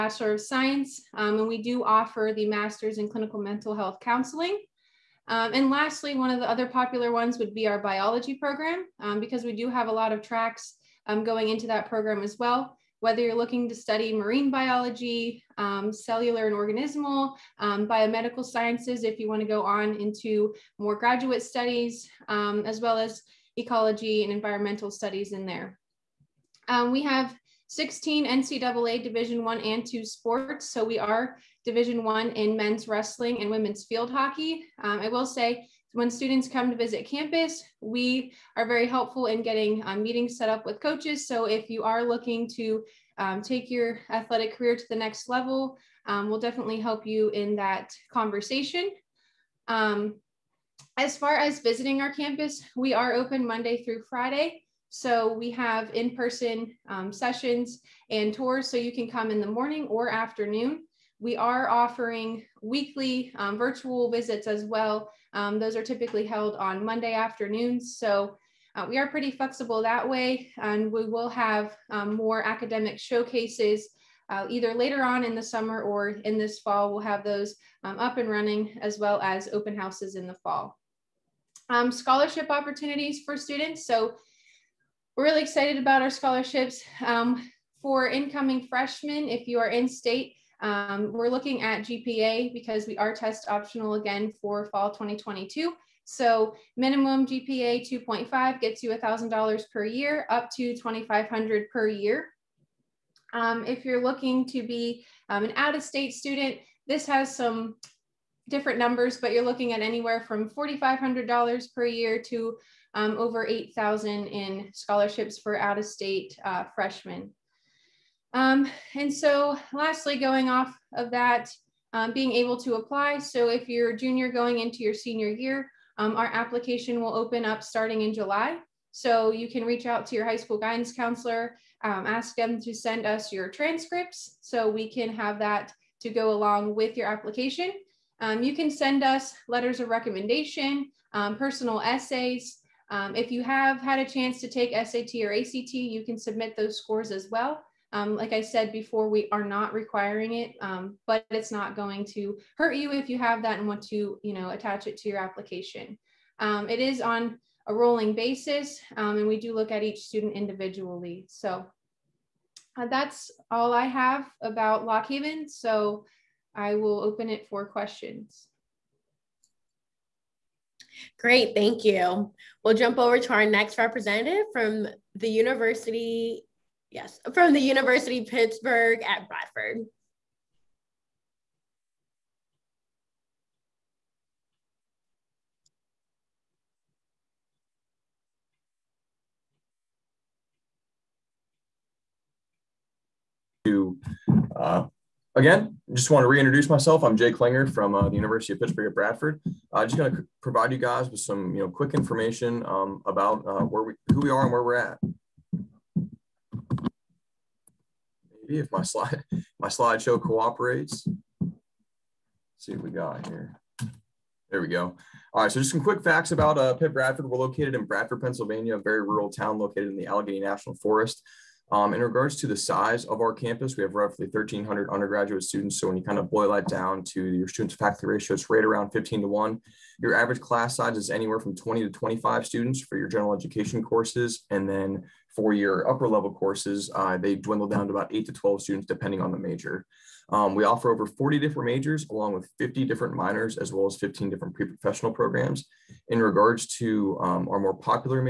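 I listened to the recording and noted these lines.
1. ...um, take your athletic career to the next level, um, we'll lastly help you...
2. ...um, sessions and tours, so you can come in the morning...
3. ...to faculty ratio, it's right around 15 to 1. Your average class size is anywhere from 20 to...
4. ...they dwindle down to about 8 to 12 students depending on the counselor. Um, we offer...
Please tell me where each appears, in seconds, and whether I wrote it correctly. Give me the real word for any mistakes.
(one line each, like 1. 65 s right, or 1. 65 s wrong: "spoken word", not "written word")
1. 43 s wrong: "definitely", not "lastly"
2. 56 s right
3. 227 s right
4. 237 s wrong: "major", not "counselor".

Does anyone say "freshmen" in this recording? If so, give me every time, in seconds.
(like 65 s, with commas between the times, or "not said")
88 s, 116 s.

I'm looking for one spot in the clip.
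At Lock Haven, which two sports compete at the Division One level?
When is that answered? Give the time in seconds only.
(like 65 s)
32 s.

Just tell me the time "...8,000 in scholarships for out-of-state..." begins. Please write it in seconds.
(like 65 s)
113 s.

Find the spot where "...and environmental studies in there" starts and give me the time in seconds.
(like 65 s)
24 s.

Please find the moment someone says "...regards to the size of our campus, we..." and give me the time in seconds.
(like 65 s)
222 s.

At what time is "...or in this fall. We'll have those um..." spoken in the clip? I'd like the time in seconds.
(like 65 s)
75 s.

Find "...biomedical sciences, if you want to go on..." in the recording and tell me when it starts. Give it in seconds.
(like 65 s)
17 s.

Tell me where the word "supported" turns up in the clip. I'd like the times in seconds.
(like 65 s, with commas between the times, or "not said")
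not said.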